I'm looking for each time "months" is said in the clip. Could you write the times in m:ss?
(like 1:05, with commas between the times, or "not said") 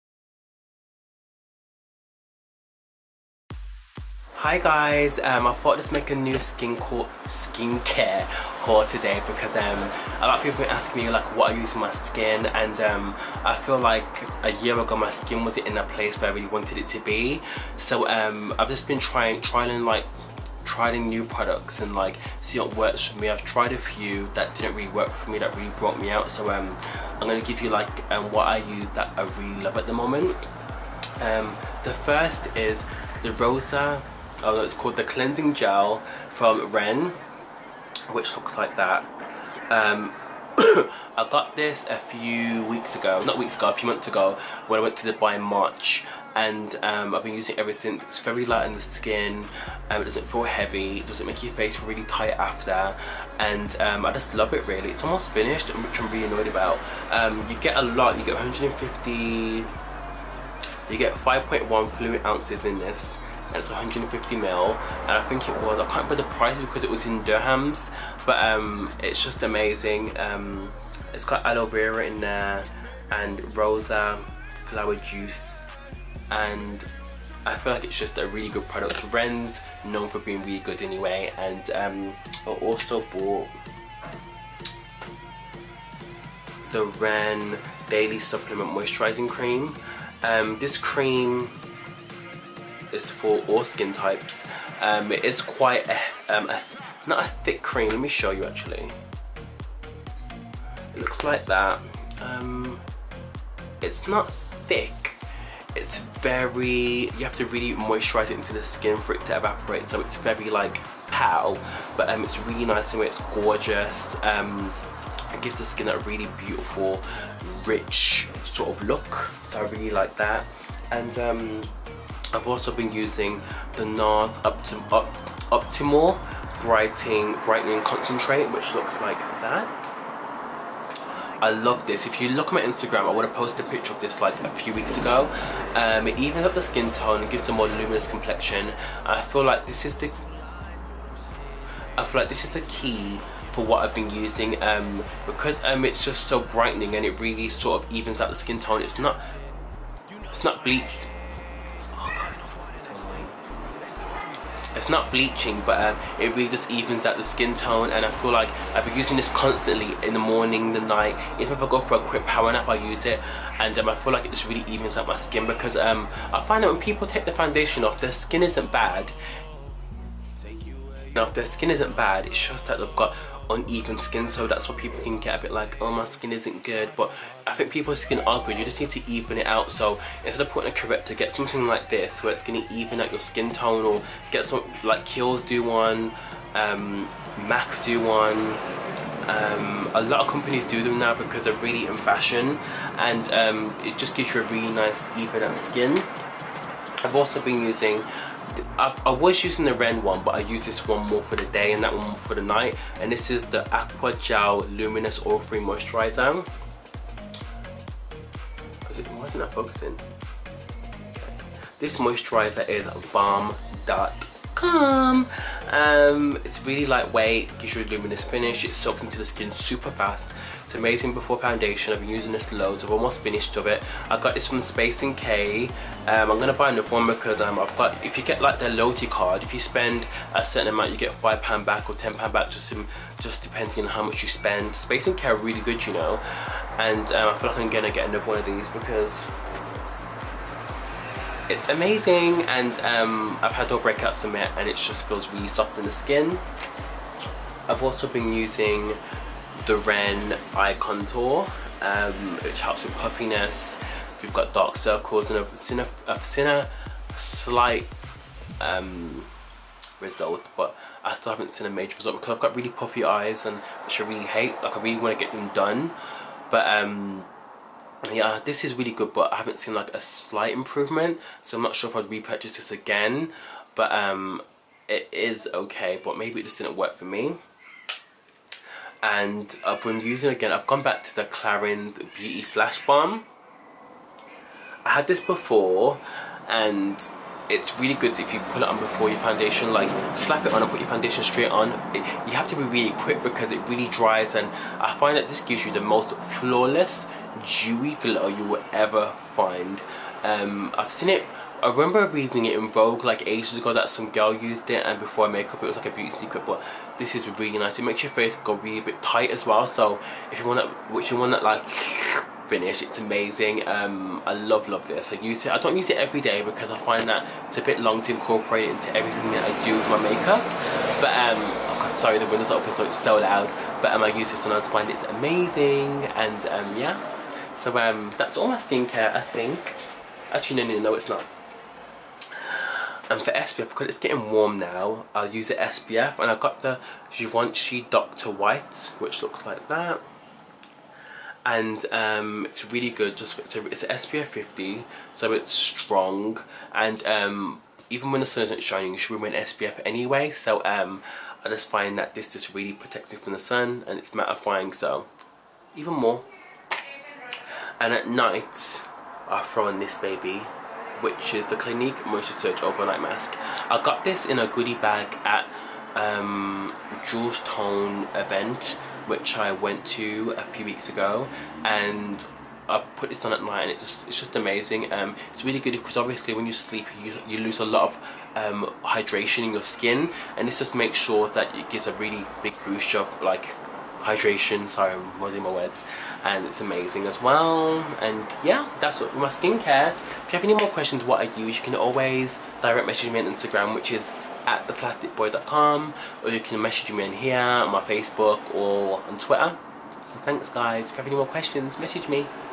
0:43.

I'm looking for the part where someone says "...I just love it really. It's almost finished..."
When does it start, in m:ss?
0:54.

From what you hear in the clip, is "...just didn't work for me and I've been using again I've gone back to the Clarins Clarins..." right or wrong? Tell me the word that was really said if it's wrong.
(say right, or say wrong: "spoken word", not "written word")
wrong: "Beauty", not "Clarins".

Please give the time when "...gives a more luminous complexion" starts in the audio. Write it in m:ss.
2:17.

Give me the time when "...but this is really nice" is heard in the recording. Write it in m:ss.
5:06.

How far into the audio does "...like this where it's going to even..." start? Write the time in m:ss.
3:01.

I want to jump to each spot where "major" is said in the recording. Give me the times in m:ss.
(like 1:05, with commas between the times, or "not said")
4:21.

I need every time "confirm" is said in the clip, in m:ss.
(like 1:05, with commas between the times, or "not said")
not said.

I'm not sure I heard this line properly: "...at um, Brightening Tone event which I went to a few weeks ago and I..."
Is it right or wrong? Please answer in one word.
wrong.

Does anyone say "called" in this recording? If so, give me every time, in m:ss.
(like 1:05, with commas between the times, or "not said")
0:06, 0:34.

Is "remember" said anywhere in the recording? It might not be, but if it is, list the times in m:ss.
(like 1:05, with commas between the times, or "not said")
1:06, 5:01.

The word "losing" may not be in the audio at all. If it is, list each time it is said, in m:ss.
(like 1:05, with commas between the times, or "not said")
6:25.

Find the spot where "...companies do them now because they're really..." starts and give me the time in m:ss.
3:10.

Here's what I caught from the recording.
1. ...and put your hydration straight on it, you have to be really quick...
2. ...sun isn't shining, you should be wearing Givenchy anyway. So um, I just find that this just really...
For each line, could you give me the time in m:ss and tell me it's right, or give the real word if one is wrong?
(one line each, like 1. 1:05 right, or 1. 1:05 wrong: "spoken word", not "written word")
1. 4:50 wrong: "foundation", not "hydration"
2. 5:48 wrong: "SPF", not "Givenchy".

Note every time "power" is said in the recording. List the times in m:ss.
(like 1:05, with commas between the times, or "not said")
2:42.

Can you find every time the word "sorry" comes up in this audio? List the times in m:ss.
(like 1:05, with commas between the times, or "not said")
5:21, 6:24.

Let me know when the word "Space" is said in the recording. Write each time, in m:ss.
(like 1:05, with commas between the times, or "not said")
3:44, 3:54.